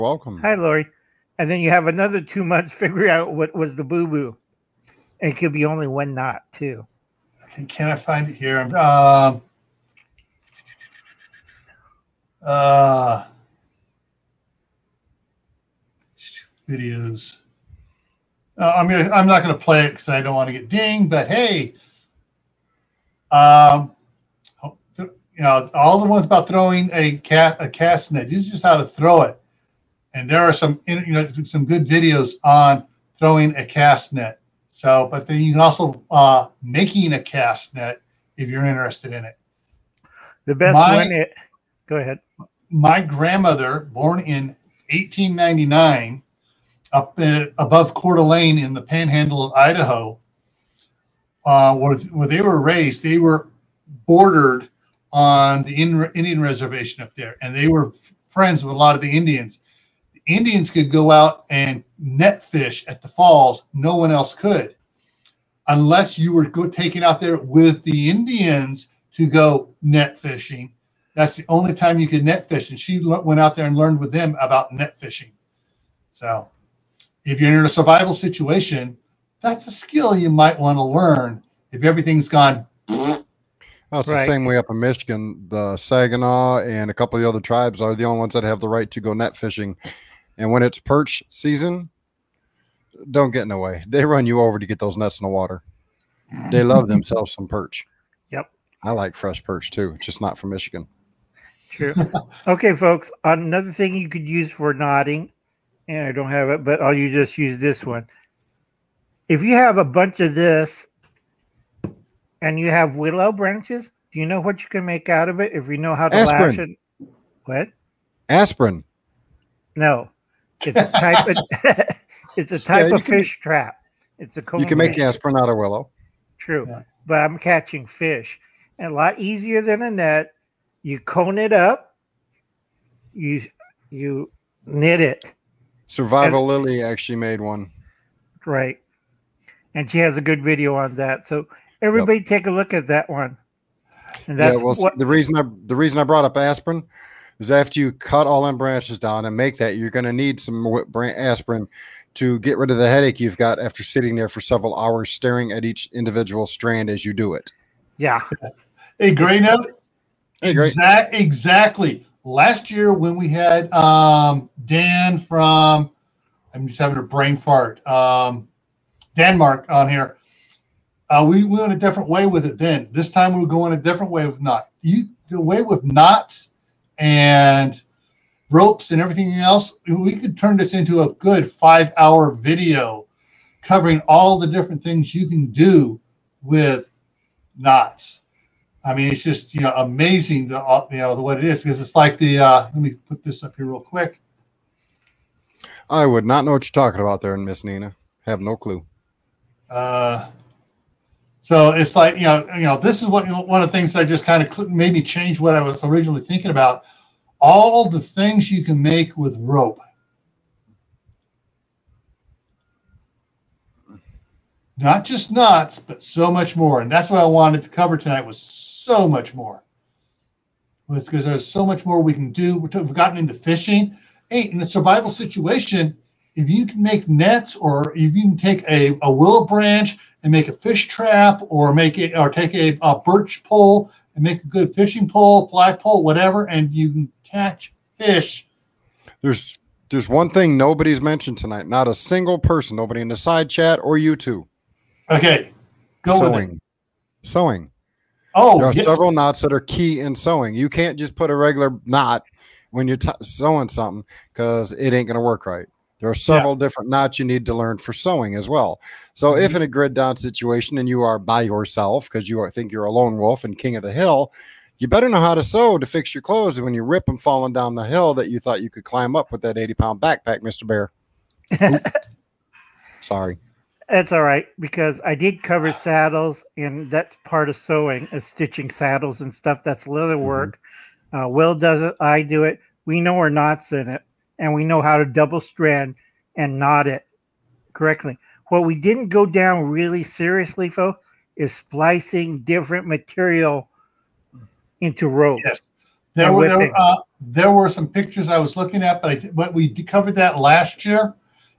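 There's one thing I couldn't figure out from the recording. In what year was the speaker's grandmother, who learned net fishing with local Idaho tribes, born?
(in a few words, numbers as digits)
1899.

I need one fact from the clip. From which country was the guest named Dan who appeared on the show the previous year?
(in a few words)
Denmark.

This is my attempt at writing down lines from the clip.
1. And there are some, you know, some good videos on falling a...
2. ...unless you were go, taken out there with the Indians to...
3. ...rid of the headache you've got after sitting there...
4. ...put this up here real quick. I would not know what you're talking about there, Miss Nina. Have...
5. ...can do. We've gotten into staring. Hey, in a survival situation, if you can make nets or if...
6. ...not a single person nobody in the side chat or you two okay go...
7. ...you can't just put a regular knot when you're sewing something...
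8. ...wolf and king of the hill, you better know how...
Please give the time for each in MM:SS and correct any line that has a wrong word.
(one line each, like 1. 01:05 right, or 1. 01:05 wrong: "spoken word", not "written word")
1. 00:30 wrong: "throwing", not "falling"
2. 01:05 right
3. 02:32 right
4. 03:12 right
5. 03:42 wrong: "fishing", not "staring"
6. 04:01 right
7. 04:10 right
8. 04:23 right.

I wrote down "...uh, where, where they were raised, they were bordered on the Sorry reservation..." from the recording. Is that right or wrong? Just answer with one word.
wrong.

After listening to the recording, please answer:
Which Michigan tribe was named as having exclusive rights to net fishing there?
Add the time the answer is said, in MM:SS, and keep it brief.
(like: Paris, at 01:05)
Saginaw, at 01:25.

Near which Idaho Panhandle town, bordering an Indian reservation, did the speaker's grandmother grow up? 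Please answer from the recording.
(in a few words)
Coeur d'Alene.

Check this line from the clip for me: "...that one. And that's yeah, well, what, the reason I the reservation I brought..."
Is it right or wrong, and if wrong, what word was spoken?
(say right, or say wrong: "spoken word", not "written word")
wrong: "reason", not "reservation".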